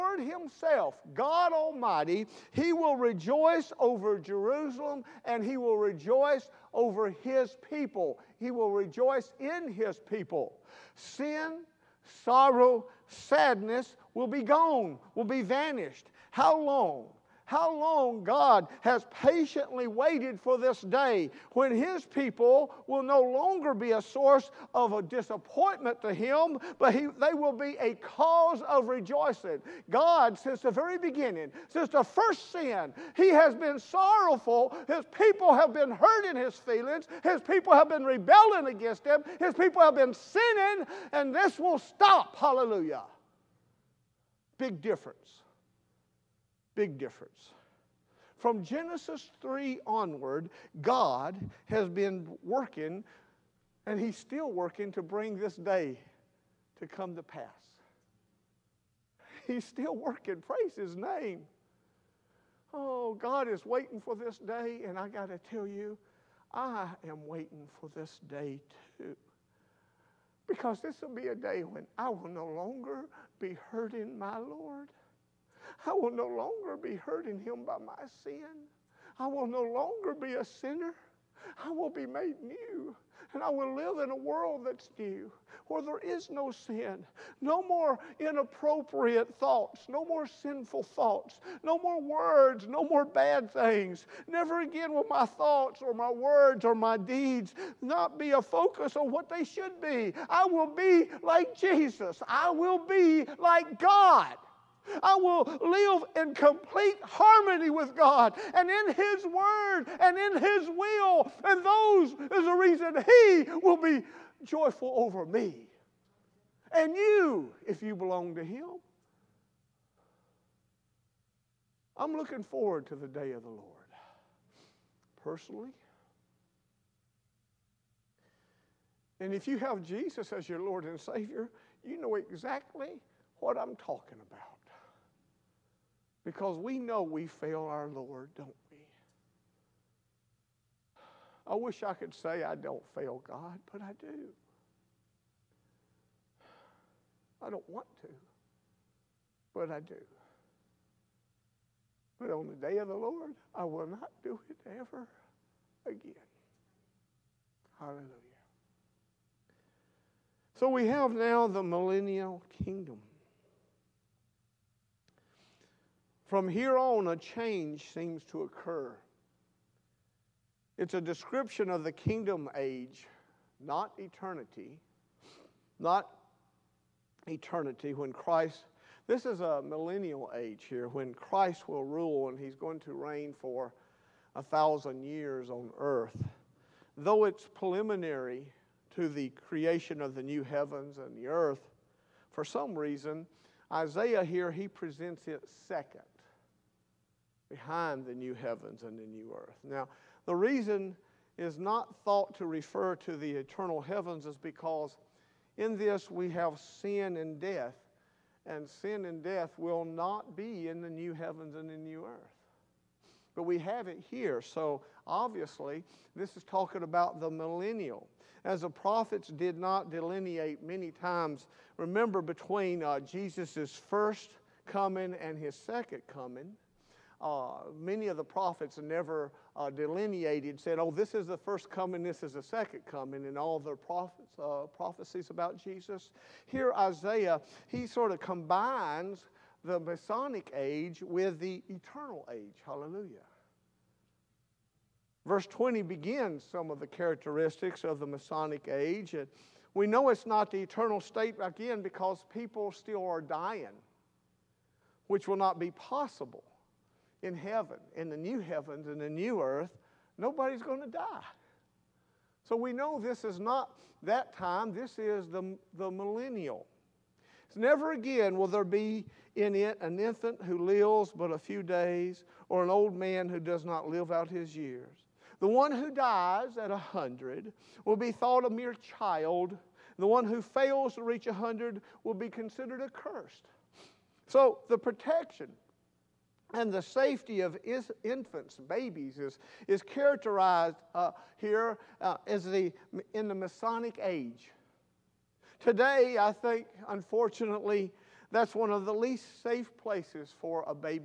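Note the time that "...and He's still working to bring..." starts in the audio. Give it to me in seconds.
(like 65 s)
53 s.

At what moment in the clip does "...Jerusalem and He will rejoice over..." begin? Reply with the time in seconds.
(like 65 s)
4 s.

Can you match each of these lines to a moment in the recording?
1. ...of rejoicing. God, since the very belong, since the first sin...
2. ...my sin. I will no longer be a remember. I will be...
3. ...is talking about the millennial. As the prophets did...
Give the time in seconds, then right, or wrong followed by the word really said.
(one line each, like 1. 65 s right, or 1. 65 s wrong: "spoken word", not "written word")
1. 28 s wrong: "beginning", not "belong"
2. 77 s wrong: "sinner", not "remember"
3. 216 s right.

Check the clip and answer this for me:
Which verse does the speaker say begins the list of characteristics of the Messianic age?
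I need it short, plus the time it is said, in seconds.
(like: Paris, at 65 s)
Verse 20, at 245 s.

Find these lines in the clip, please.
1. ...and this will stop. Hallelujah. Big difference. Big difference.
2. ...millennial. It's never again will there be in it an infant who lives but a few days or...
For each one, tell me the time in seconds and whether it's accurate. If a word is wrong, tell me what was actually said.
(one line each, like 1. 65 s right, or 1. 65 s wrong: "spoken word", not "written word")
1. 41 s right
2. 265 s right.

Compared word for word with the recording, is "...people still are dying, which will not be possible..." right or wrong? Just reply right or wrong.
right.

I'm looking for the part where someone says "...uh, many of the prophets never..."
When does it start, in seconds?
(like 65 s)
227 s.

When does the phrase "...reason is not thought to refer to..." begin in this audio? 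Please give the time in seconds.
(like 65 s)
200 s.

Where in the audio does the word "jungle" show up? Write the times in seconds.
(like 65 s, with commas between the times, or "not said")
not said.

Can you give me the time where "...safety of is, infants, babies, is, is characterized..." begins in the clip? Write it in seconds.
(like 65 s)
286 s.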